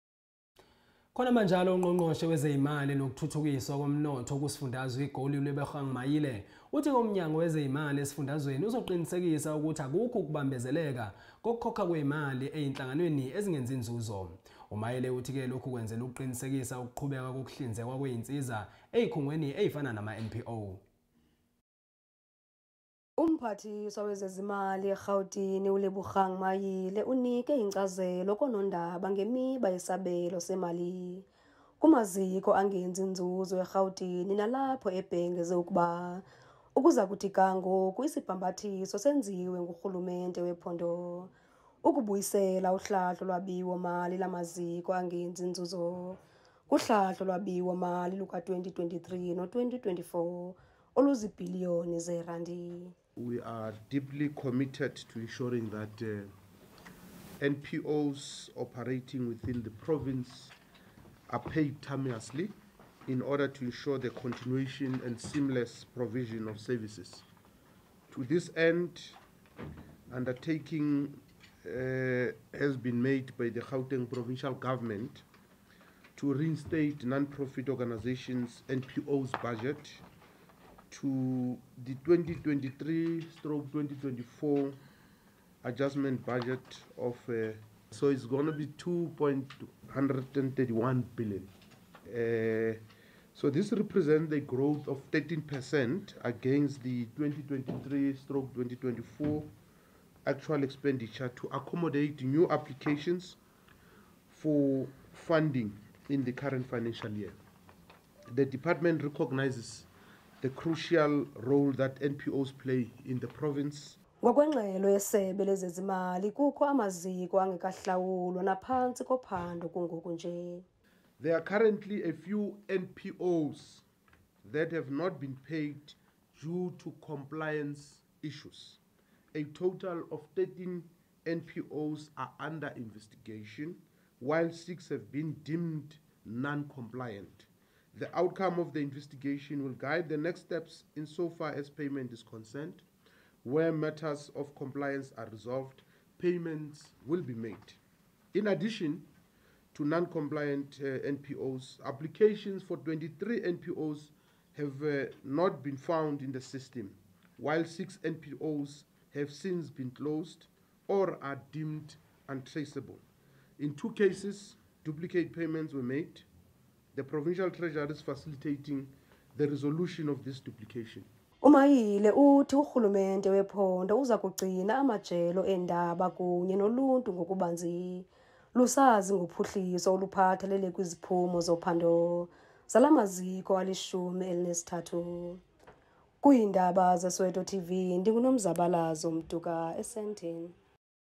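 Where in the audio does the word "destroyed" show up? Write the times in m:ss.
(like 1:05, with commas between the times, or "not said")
not said.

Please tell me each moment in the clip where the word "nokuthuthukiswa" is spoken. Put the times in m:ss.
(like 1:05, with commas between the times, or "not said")
0:02.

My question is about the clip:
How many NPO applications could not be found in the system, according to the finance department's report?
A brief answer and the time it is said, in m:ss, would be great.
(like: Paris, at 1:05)
23, at 2:32.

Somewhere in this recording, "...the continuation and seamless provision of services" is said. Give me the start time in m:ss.
1:03.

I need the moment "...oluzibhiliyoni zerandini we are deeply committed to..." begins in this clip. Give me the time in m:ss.
0:50.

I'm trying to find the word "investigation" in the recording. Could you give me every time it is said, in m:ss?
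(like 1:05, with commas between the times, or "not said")
2:12, 2:18.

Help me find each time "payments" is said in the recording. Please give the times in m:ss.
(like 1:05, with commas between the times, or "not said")
2:21, 2:26, 2:45.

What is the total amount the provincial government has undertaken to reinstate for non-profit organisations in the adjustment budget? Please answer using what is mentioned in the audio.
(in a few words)
2.131 billion.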